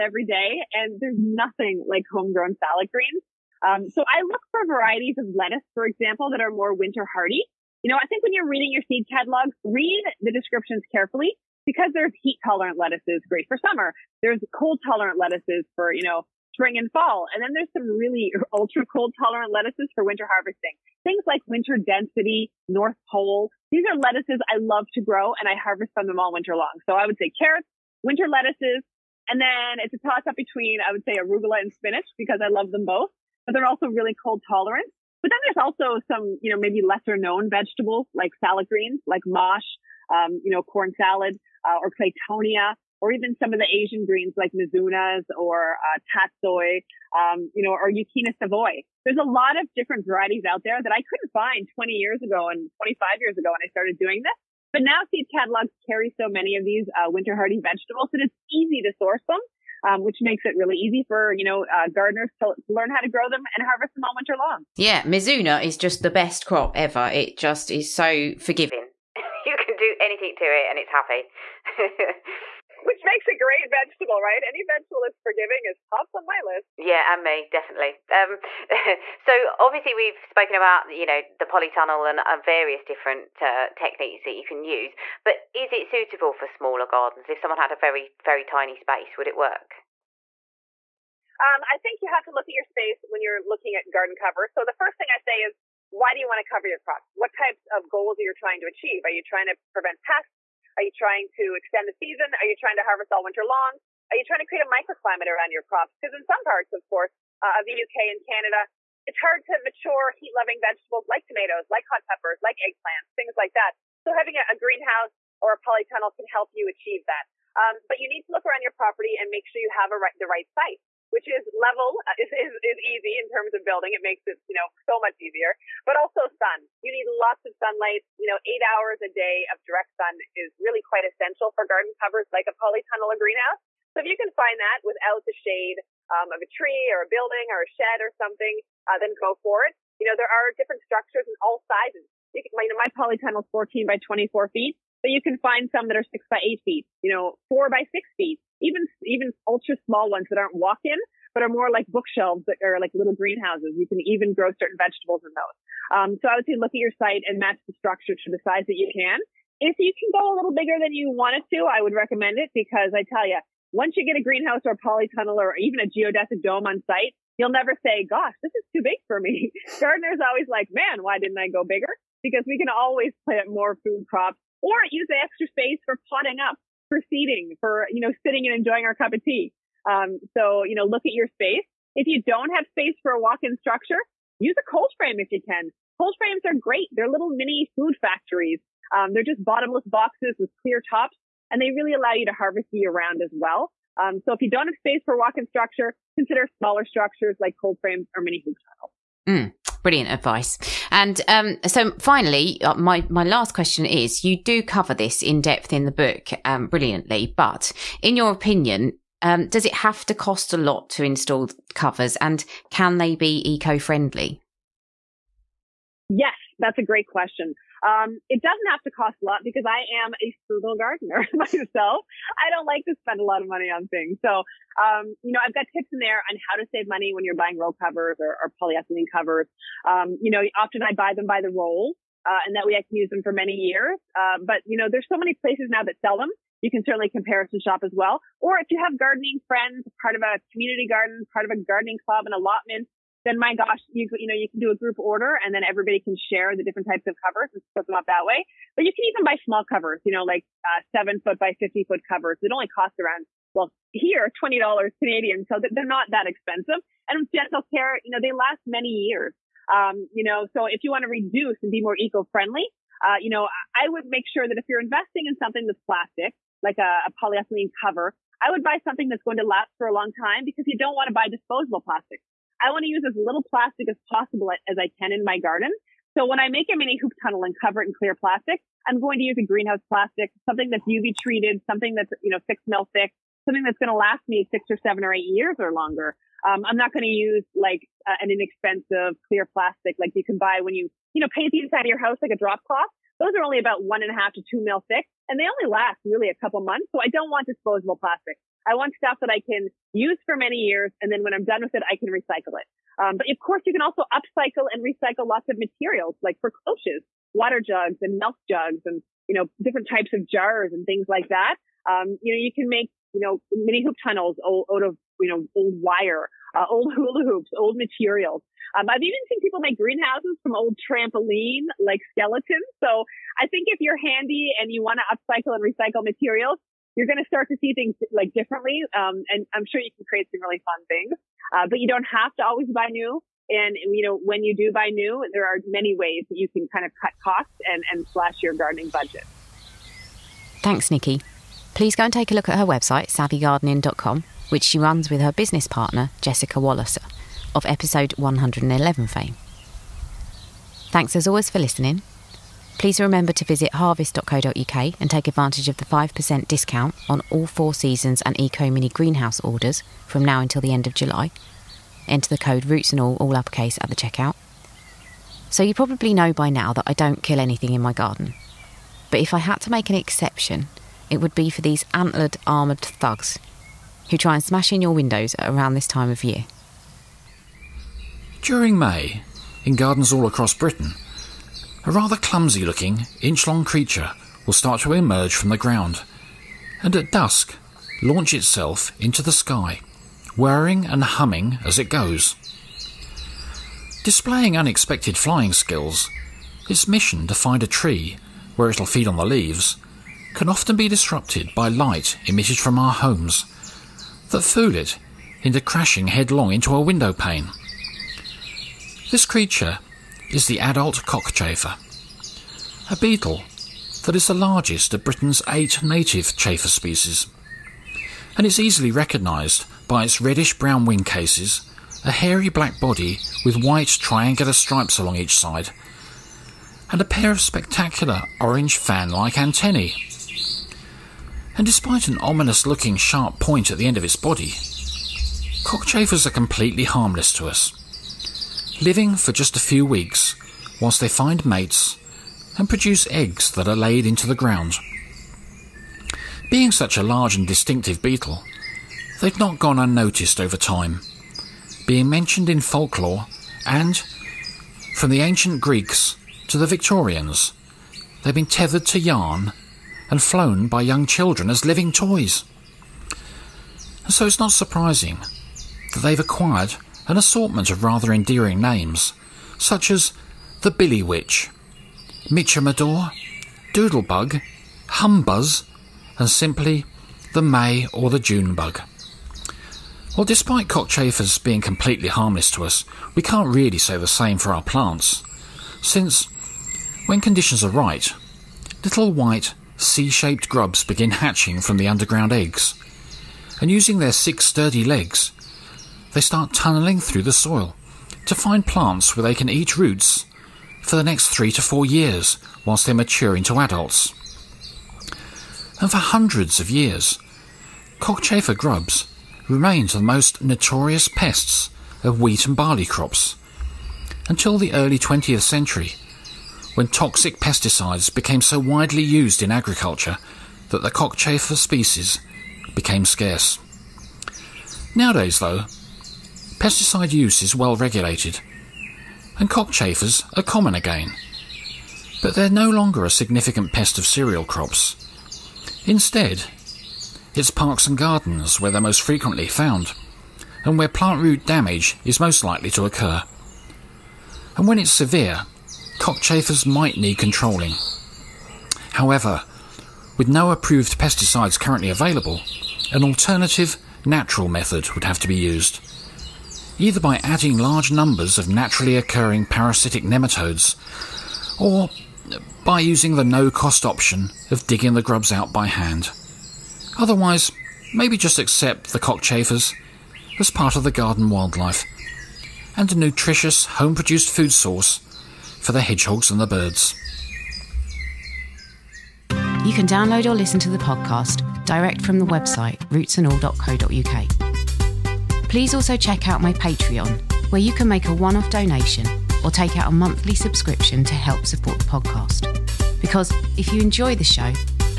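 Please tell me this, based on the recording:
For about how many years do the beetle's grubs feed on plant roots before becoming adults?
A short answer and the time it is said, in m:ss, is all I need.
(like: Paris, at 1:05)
3 to 4 years, at 8:21.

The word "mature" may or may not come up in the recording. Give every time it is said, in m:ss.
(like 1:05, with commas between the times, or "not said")
1:49, 8:22.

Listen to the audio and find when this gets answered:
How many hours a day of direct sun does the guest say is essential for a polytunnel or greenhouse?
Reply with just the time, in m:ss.
2:08.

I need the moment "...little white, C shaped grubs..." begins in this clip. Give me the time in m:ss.
8:08.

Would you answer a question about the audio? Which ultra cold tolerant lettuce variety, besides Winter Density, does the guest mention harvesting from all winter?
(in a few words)
North Pole.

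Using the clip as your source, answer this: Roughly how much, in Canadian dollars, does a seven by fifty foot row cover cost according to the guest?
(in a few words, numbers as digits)
$20.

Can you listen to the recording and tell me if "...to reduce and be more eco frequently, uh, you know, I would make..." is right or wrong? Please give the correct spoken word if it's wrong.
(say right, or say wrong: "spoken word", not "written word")
wrong: "friendly", not "frequently".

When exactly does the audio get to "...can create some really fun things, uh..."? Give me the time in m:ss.
5:29.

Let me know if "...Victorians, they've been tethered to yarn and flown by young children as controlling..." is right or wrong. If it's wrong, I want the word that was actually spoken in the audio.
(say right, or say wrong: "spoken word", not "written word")
wrong: "living", not "controlling".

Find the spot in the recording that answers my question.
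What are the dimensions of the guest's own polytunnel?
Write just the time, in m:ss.
2:23.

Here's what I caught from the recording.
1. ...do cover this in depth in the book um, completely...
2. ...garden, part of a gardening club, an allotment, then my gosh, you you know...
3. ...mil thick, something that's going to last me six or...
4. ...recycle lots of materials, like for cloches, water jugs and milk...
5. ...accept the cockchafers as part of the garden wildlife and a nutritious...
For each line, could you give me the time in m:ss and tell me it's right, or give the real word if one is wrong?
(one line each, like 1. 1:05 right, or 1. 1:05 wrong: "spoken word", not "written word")
1. 3:24 wrong: "brilliantly", not "completely"
2. 4:00 right
3. 4:42 right
4. 5:04 right
5. 9:28 right.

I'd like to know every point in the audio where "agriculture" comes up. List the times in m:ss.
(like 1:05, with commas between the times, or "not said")
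8:39.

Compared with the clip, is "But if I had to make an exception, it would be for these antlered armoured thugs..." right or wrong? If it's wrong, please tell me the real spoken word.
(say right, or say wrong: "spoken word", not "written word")
right.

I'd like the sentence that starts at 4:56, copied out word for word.
So I don't want disposable plastic.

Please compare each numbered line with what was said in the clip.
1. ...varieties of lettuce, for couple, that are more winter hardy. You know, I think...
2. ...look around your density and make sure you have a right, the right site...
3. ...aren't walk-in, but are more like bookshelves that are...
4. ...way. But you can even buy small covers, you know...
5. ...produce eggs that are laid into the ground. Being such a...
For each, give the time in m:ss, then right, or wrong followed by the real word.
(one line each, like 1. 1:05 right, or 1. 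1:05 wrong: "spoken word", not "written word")
1. 0:04 wrong: "example", not "couple"
2. 1:58 wrong: "property", not "density"
3. 2:30 right
4. 4:08 right
5. 7:22 right.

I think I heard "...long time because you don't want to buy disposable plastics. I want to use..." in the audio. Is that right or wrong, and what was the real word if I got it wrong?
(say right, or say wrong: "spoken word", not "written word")
right.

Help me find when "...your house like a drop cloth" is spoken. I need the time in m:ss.
4:51.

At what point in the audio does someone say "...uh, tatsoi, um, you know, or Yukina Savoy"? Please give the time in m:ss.
0:45.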